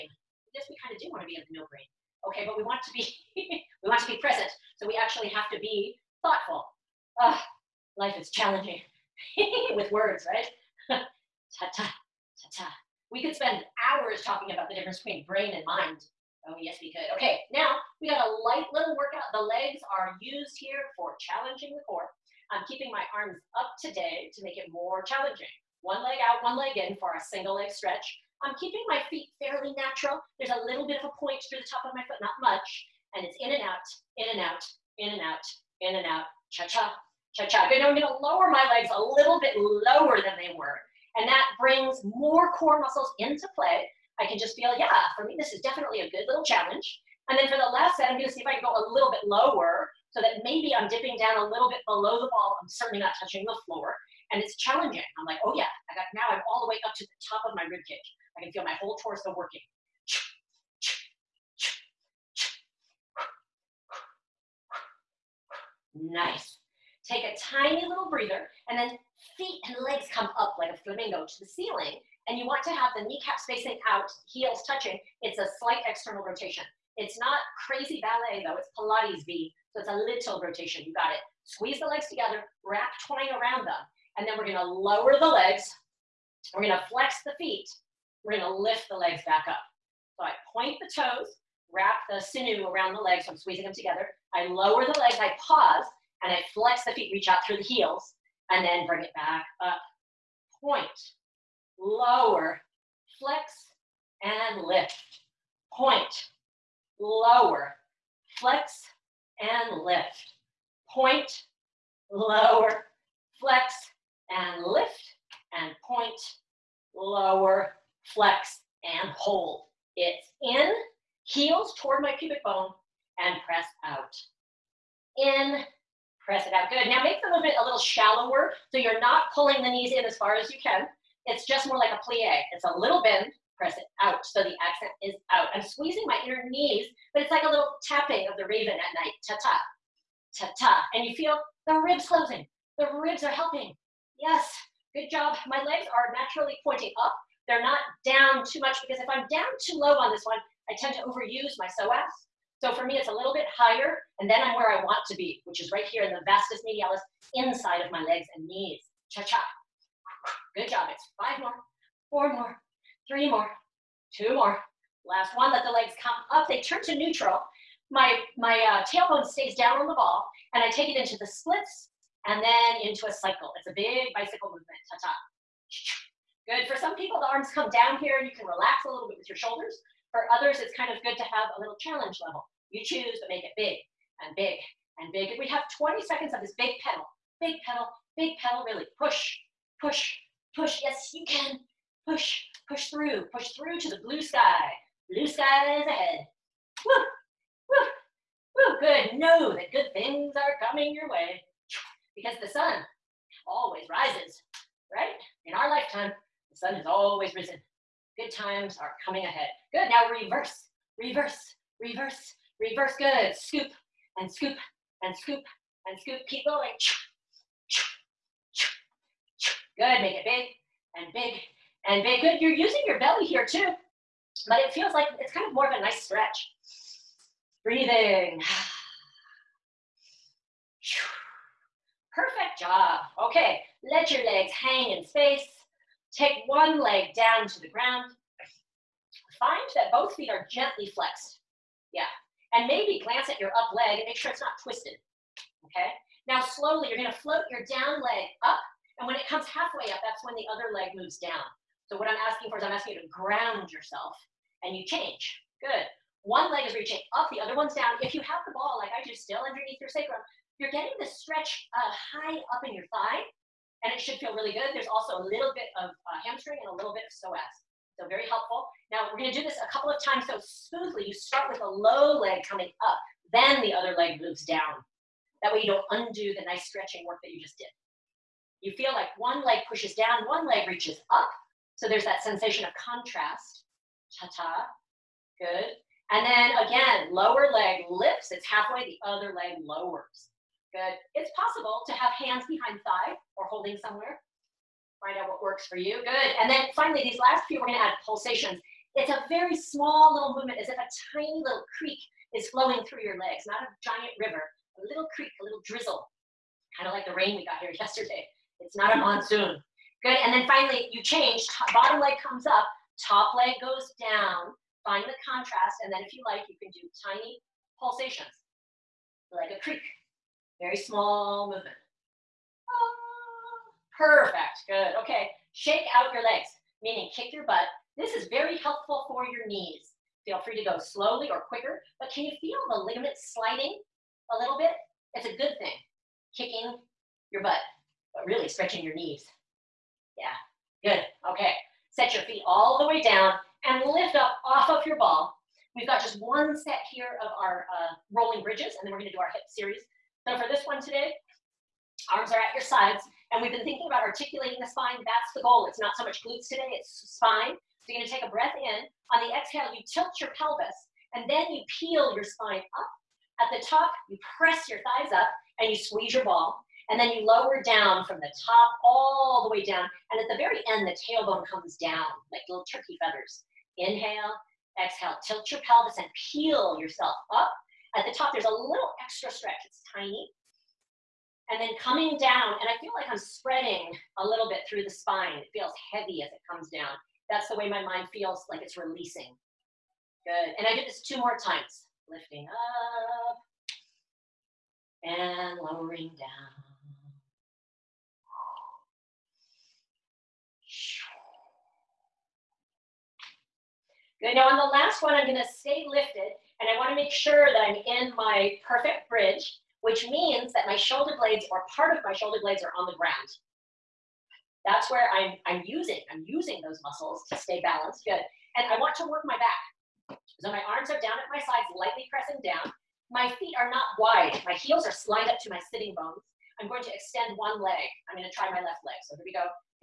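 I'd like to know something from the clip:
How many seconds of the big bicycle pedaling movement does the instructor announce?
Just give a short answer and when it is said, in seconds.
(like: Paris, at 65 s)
20, at 185 s.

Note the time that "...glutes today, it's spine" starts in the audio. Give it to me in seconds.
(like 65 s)
356 s.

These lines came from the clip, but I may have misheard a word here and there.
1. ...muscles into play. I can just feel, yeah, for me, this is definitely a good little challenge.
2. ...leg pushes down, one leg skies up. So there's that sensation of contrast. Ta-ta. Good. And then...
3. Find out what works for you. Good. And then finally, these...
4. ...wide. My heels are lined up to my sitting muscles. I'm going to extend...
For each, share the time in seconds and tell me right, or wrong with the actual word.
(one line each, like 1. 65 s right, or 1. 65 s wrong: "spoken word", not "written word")
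1. 42 s right
2. 279 s wrong: "reaches", not "skies"
3. 295 s right
4. 423 s wrong: "bones", not "muscles".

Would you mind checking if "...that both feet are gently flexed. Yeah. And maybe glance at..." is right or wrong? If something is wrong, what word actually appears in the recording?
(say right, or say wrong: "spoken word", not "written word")
right.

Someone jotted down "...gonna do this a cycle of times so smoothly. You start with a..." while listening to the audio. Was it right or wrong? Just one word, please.
wrong.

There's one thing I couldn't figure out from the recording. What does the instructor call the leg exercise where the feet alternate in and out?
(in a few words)
single leg stretch.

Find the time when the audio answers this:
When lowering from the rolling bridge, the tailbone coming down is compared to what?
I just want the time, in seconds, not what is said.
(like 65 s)
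372 s.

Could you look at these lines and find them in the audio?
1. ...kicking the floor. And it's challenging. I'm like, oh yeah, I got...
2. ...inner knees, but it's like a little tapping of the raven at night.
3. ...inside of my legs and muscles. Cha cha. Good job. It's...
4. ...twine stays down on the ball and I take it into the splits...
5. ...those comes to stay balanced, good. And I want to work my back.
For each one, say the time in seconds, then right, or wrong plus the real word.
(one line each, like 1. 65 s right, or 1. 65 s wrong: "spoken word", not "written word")
1. 53 s wrong: "touching", not "kicking"
2. 136 s right
3. 157 s wrong: "knees", not "muscles"
4. 168 s wrong: "tailbone", not "twine"
5. 416 s wrong: "muscles", not "comes".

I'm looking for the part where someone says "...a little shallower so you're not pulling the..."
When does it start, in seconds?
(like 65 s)
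127 s.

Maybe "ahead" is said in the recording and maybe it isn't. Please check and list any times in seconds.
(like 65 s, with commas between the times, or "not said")
195 s, 209 s.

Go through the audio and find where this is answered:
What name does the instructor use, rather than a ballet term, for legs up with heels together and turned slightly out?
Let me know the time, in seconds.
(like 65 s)
78 s.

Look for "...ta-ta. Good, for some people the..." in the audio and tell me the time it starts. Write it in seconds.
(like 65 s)
174 s.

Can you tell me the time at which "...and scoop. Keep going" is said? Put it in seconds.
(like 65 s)
215 s.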